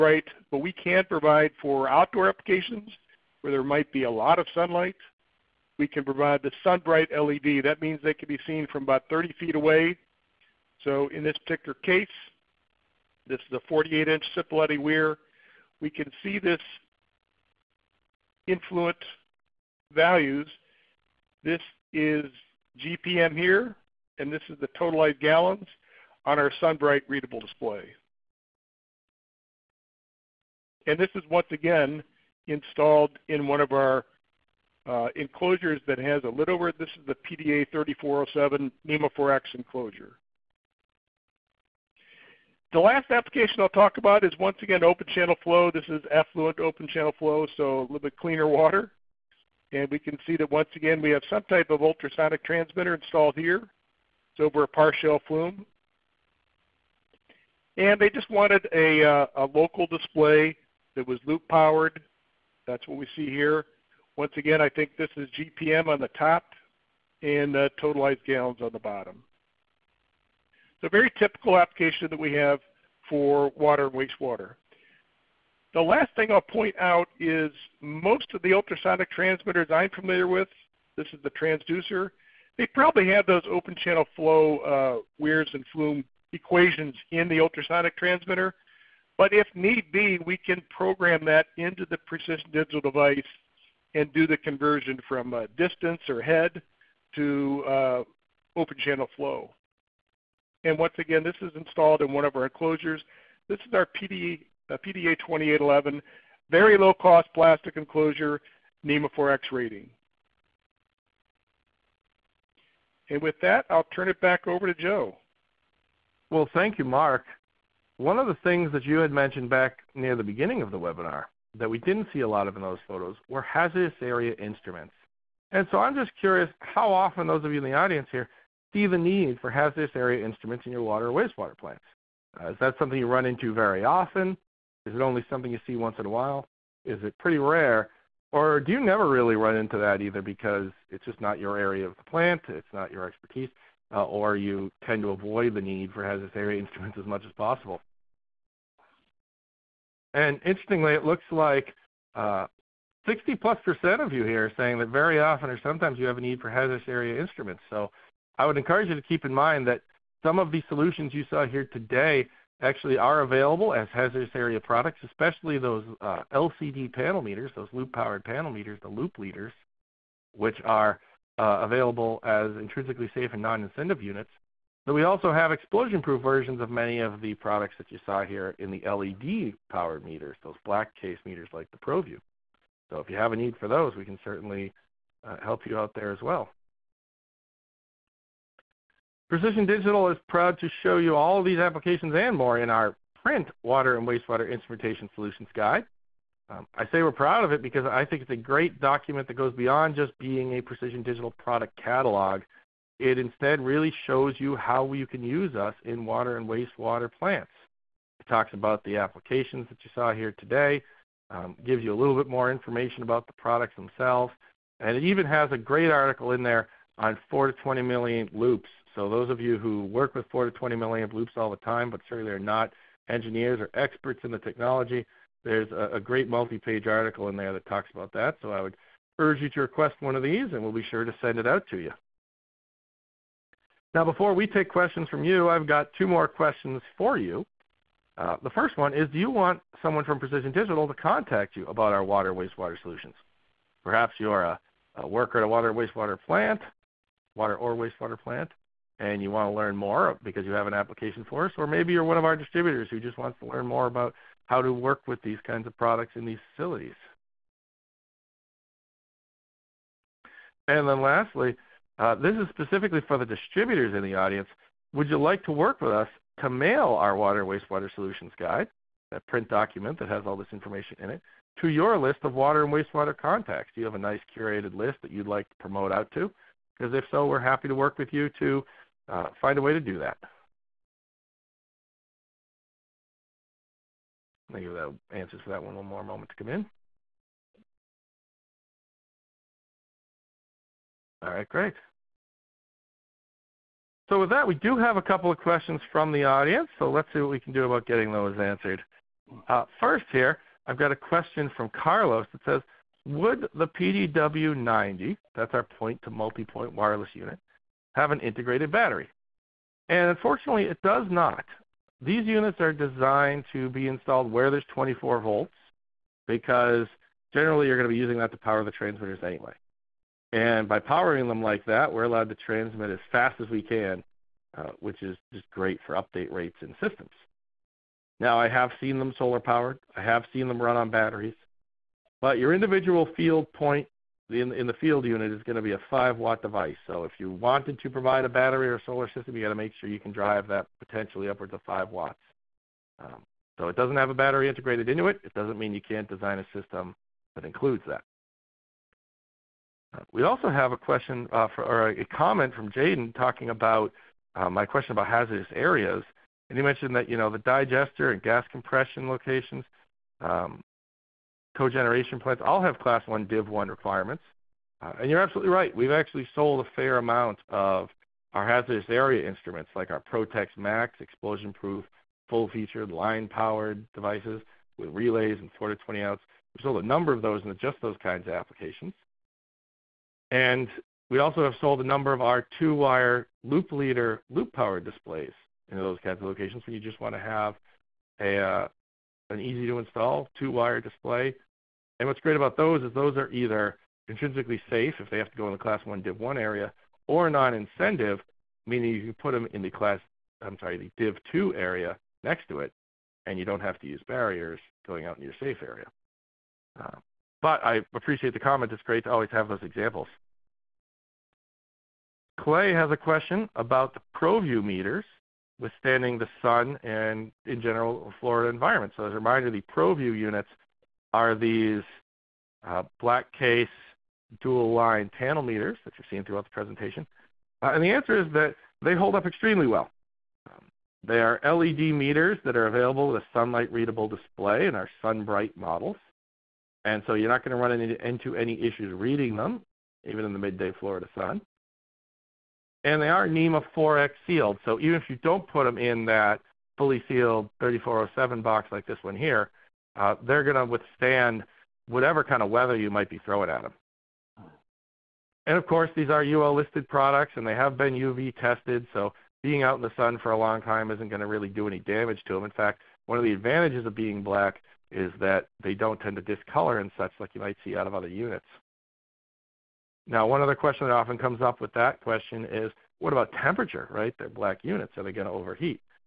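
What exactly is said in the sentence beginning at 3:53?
Now, before we take questions from you, I've got two more questions for you.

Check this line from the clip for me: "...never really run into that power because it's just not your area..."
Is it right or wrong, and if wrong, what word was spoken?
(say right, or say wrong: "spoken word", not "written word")
wrong: "either", not "power".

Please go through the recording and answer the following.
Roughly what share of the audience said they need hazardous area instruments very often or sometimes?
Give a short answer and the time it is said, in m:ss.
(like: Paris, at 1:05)
60 plus percent, at 2:33.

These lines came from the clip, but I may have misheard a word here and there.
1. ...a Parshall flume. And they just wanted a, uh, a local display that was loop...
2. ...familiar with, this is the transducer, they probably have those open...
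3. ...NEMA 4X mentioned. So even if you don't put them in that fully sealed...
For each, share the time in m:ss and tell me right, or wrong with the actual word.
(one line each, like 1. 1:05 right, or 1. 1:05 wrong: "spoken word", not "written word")
1. 0:54 right
2. 1:19 right
3. 7:23 wrong: "sealed", not "mentioned".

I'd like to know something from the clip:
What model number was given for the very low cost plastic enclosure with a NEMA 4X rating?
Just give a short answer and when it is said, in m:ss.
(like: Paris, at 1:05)
PDA 2811, at 1:44.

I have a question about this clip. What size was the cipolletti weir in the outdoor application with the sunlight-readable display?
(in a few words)
48-inch.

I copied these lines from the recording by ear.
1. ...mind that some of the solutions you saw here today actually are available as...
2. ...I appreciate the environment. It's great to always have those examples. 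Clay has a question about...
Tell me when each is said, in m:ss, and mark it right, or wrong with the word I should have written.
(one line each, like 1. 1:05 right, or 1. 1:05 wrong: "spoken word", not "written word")
1. 2:39 right
2. 6:47 wrong: "comment", not "environment".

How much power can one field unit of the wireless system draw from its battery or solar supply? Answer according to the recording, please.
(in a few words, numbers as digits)
5 watts.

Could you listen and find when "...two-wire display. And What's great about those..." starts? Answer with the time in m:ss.
6:30.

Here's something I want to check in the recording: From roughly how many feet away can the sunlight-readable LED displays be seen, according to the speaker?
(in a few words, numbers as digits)
30 feet.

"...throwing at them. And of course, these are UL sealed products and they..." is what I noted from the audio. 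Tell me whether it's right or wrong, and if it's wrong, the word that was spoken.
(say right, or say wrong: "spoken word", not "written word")
wrong: "listed", not "sealed".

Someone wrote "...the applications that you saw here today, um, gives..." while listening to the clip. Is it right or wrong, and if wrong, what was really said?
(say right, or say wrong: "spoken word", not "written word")
right.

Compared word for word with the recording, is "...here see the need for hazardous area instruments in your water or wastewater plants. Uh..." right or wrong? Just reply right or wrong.
right.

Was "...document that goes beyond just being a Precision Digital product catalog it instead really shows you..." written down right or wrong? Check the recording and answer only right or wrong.
right.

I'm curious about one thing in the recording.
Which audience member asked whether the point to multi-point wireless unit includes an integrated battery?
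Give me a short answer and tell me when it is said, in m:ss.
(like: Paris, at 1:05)
Carlos, at 5:01.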